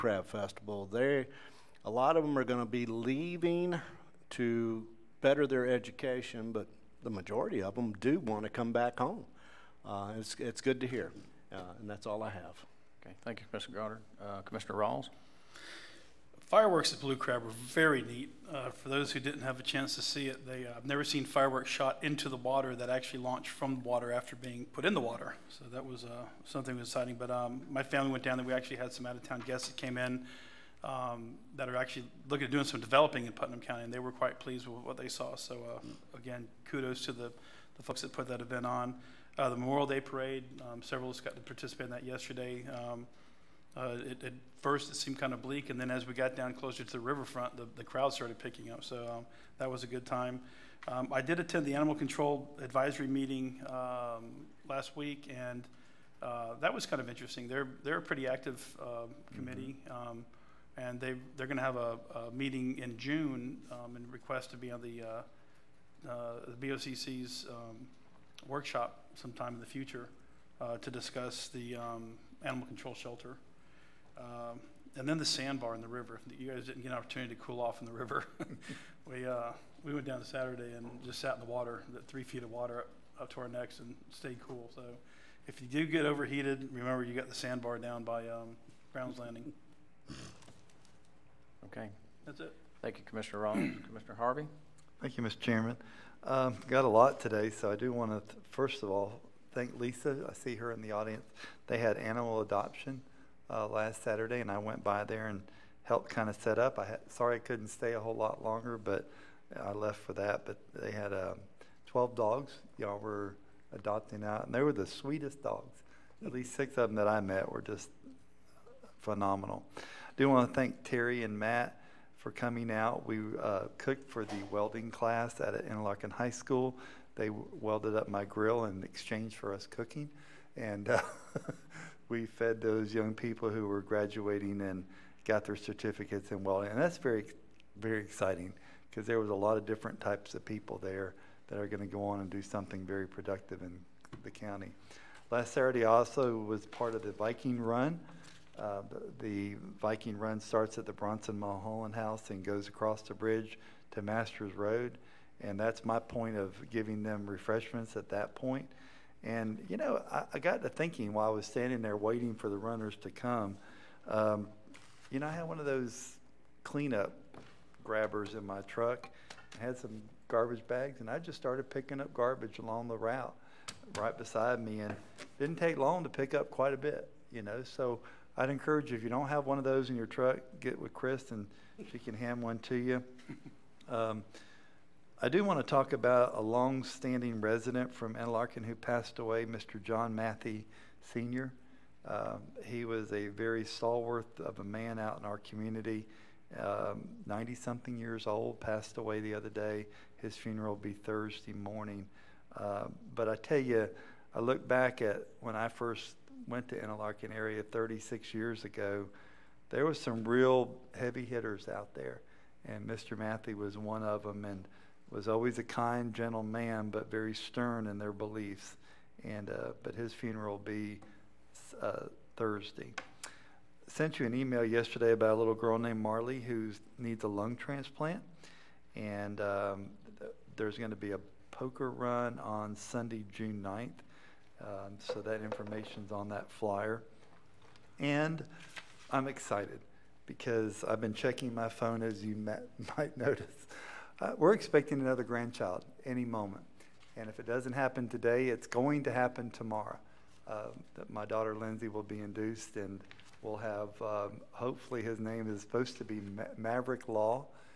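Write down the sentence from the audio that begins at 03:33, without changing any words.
Matthew was one of them, and was always a kind, gentle man, but very stern in their beliefs.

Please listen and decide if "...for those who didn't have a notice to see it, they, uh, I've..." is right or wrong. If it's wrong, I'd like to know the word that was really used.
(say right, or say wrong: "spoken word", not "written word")
wrong: "chance", not "notice".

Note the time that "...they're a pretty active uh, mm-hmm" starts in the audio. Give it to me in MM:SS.
00:57.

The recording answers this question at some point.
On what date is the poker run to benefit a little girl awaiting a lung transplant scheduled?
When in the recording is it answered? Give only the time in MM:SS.
03:52.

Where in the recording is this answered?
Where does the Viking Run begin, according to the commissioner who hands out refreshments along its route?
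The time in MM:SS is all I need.
02:30.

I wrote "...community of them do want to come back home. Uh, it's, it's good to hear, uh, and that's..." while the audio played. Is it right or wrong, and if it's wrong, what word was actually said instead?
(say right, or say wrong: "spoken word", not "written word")
wrong: "majority", not "community".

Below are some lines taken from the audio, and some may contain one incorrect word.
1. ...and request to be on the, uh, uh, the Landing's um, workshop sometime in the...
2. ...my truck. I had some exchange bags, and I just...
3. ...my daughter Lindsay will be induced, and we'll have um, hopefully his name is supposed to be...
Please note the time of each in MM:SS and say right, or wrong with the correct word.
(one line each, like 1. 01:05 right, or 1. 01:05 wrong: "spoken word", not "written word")
1. 01:03 wrong: "BOCC", not "Landing"
2. 02:48 wrong: "garbage", not "exchange"
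3. 04:11 right.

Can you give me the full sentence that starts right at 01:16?
You guys didn't get an opportunity to cool off in the river.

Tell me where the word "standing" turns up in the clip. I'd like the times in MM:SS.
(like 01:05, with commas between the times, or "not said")
02:41, 03:06.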